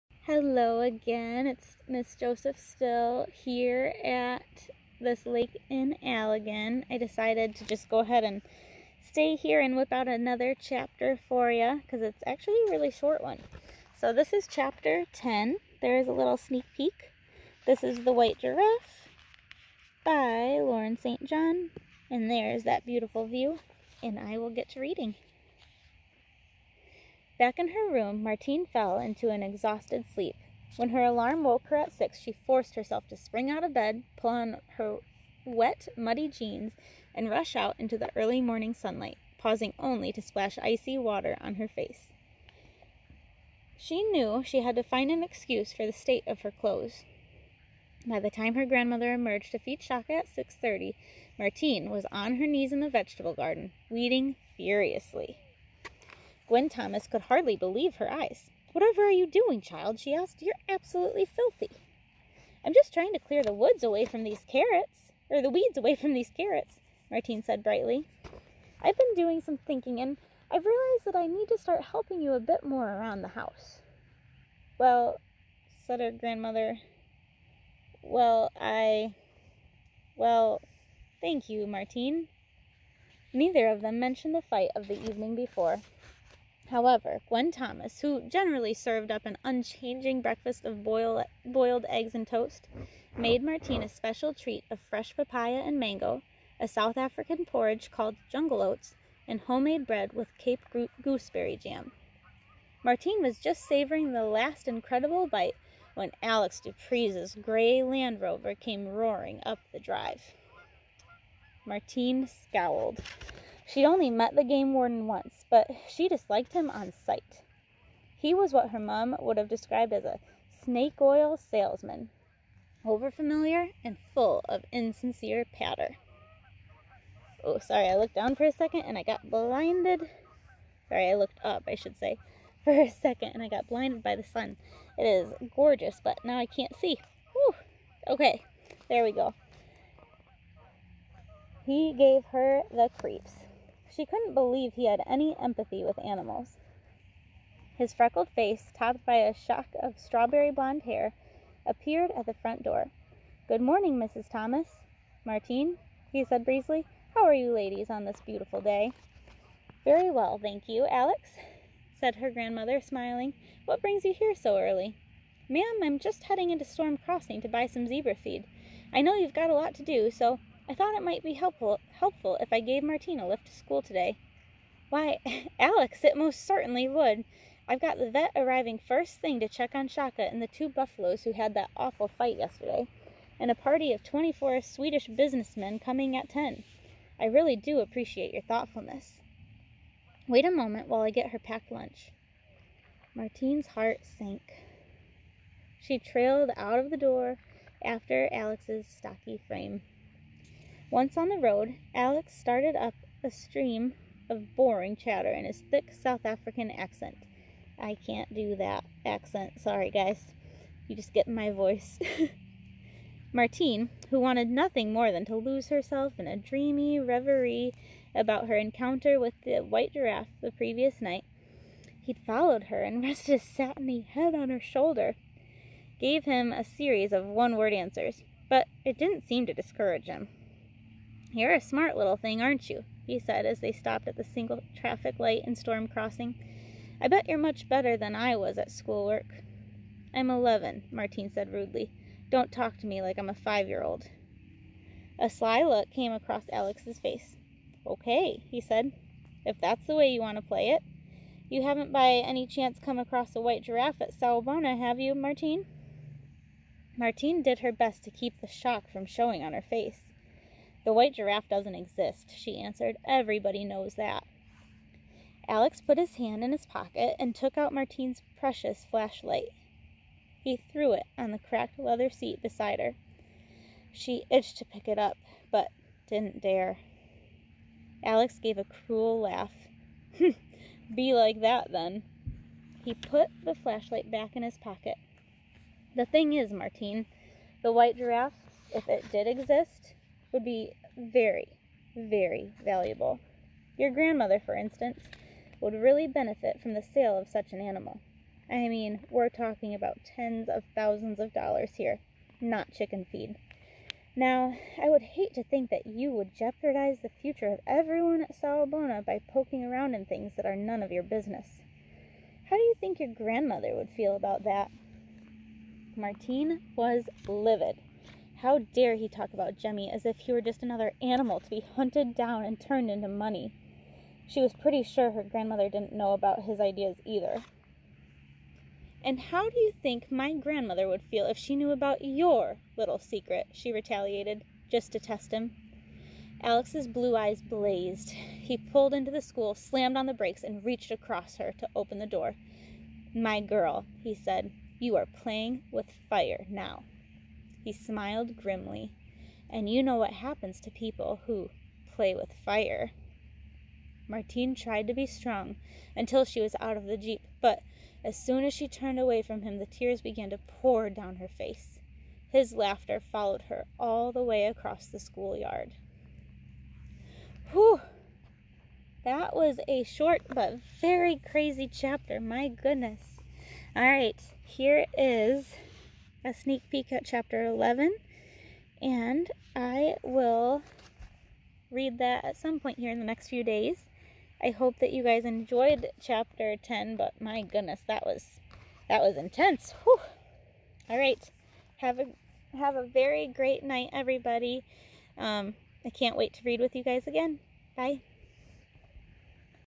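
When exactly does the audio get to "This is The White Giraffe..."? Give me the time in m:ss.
0:17.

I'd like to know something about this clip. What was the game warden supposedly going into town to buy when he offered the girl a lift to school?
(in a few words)
zebra feed.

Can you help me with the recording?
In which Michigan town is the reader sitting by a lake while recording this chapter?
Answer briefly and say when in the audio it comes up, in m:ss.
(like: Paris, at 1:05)
Allegan, at 0:06.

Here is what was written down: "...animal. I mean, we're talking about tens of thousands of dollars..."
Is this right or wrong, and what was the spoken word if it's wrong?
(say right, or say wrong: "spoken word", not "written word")
right.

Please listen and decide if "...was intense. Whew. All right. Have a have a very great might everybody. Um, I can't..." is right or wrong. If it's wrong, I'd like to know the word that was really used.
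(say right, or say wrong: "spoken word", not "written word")
wrong: "night", not "might".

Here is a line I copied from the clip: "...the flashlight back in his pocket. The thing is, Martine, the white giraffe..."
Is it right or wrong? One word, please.
right.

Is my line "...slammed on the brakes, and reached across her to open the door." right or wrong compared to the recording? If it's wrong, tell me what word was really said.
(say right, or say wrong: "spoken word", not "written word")
right.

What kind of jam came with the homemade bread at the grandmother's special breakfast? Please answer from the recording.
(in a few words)
Cape gooseberry jam.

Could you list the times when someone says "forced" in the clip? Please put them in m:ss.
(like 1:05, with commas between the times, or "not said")
0:32.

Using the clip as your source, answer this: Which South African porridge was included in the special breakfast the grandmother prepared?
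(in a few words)
jungle oats.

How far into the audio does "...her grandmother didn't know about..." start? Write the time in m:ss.
5:25.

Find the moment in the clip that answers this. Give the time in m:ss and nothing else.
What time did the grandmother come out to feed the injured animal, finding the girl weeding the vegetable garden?
0:50.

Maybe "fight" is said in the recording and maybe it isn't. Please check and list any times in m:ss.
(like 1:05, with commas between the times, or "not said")
1:24, 3:02.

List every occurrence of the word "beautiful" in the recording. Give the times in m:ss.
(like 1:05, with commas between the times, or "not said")
0:22, 2:38.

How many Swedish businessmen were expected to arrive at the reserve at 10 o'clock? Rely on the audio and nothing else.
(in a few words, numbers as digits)
24.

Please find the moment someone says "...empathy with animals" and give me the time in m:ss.
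2:25.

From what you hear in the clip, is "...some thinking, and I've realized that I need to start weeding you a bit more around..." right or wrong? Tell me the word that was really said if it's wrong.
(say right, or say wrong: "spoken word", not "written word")
wrong: "helping", not "weeding".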